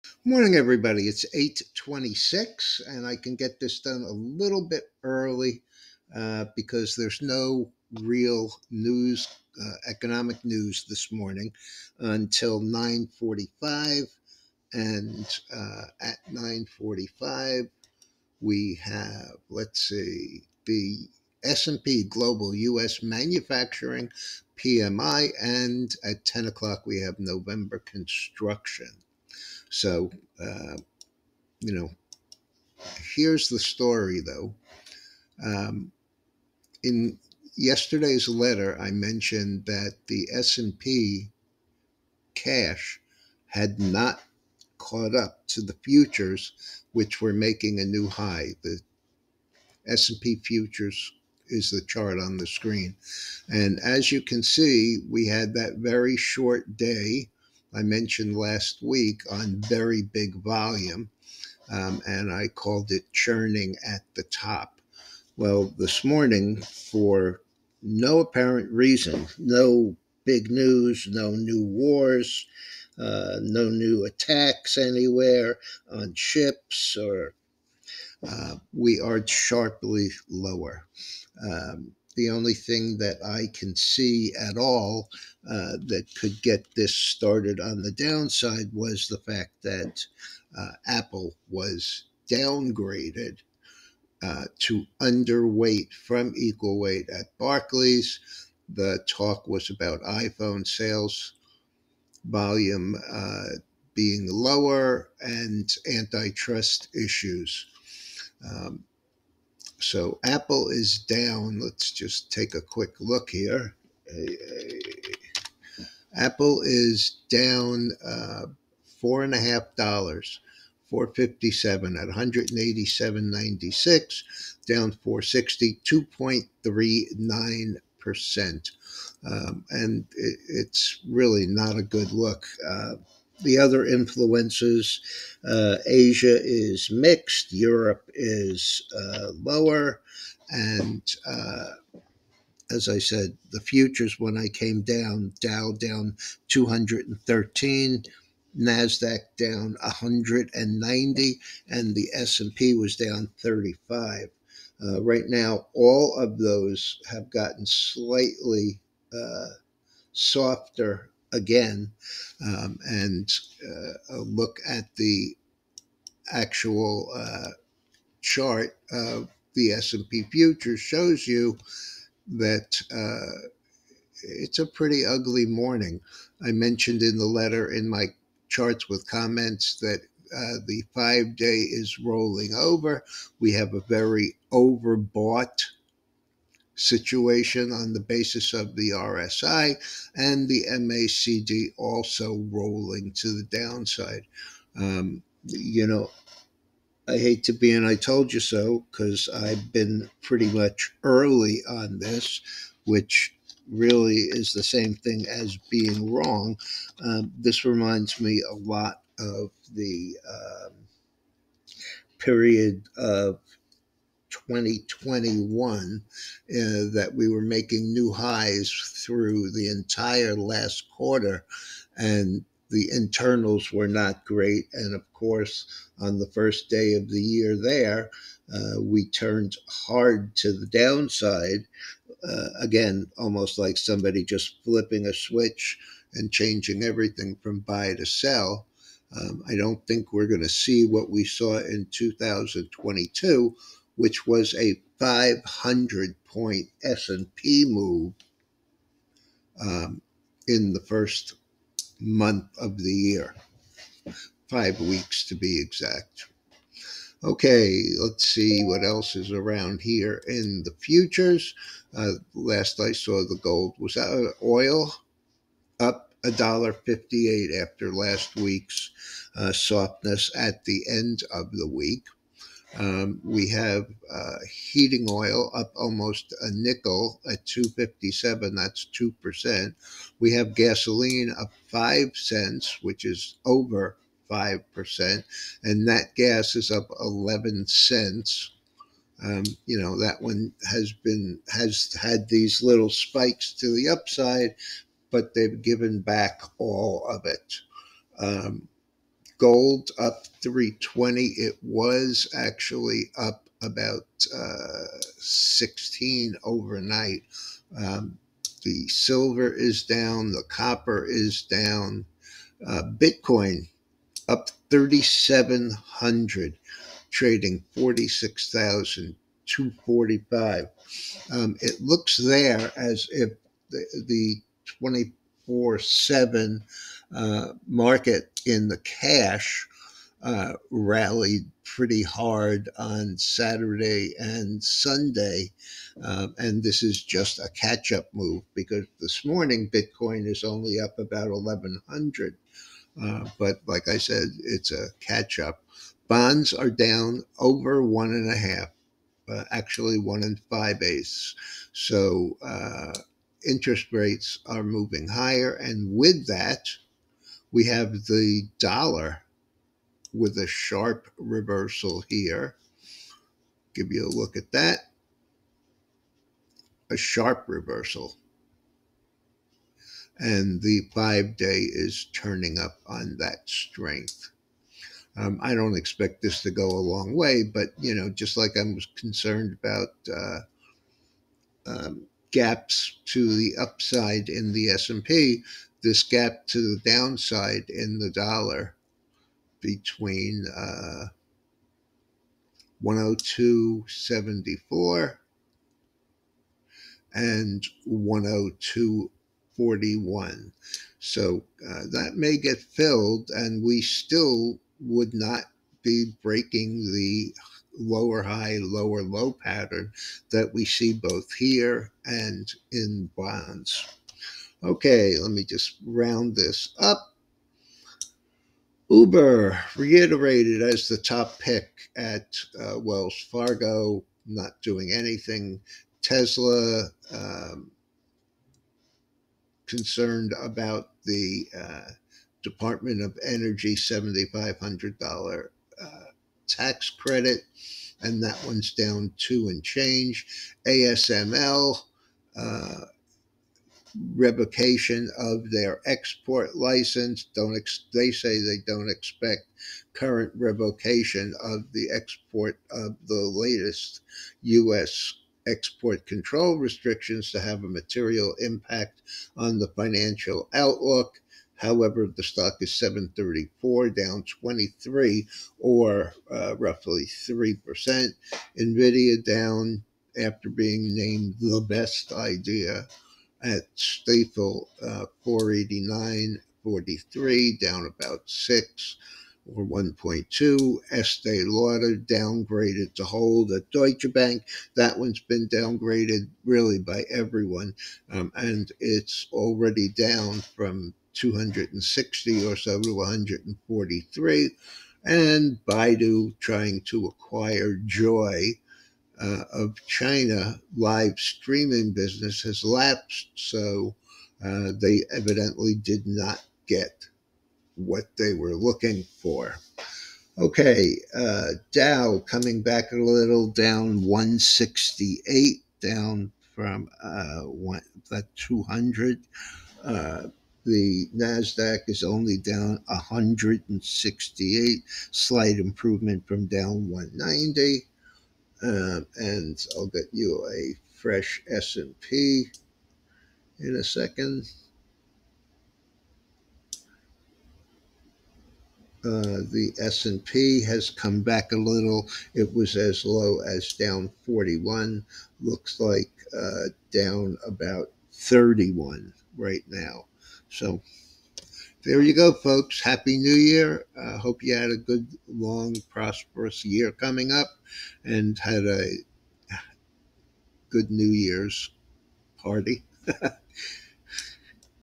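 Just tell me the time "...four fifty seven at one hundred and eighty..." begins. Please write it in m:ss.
2:00.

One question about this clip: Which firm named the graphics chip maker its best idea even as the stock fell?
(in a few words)
Stifel.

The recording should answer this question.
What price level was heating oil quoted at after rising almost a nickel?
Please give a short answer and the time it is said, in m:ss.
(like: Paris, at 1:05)
257, at 4:37.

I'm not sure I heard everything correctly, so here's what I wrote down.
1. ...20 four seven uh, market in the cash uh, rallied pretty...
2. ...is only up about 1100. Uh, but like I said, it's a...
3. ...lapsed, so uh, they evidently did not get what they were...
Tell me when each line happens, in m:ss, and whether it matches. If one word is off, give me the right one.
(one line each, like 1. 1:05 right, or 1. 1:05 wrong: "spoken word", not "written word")
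1. 5:24 right
2. 5:40 right
3. 8:22 right.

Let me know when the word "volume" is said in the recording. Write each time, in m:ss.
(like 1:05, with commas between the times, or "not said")
1:00, 1:42.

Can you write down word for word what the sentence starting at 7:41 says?
However, the stock is 734, down 23 or uh, roughly 3%.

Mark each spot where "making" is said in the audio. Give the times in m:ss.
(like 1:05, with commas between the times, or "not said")
0:47, 3:37.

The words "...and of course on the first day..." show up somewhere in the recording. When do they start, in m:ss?
3:44.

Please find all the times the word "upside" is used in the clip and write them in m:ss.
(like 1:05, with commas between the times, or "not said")
4:53, 6:23.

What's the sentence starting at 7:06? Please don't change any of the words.
Tesla um, concerned about the uh, Department of Energy $7,500 uh, tax credit, and that one's down two and change.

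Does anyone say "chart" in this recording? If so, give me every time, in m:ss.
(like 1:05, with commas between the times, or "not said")
0:51, 2:48, 2:58.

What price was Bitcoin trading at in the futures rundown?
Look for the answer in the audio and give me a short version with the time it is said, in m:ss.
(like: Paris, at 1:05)
46,245, at 5:17.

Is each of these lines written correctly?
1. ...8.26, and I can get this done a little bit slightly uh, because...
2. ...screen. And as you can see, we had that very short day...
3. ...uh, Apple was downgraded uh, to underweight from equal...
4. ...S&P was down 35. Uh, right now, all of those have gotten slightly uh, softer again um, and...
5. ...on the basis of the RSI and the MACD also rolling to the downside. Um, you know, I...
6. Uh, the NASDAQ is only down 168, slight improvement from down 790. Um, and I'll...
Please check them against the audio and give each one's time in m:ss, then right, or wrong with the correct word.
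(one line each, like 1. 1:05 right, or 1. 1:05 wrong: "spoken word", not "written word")
1. 0:01 wrong: "early", not "slightly"
2. 0:52 right
3. 1:30 right
4. 2:32 right
5. 3:07 right
6. 8:39 wrong: "190", not "790".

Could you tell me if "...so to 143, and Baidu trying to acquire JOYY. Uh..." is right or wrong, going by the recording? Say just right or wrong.
right.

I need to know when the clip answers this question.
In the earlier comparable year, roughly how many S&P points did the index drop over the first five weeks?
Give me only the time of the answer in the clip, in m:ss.
4:04.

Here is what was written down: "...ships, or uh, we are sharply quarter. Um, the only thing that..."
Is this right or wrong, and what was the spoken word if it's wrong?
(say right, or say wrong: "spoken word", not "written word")
wrong: "lower", not "quarter".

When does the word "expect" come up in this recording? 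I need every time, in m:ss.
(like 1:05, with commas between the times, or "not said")
6:15, 7:28.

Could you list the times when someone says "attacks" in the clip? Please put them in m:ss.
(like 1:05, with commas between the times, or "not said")
1:14.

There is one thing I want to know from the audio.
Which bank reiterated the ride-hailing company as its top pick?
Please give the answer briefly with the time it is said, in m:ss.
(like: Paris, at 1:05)
Wells Fargo, at 7:02.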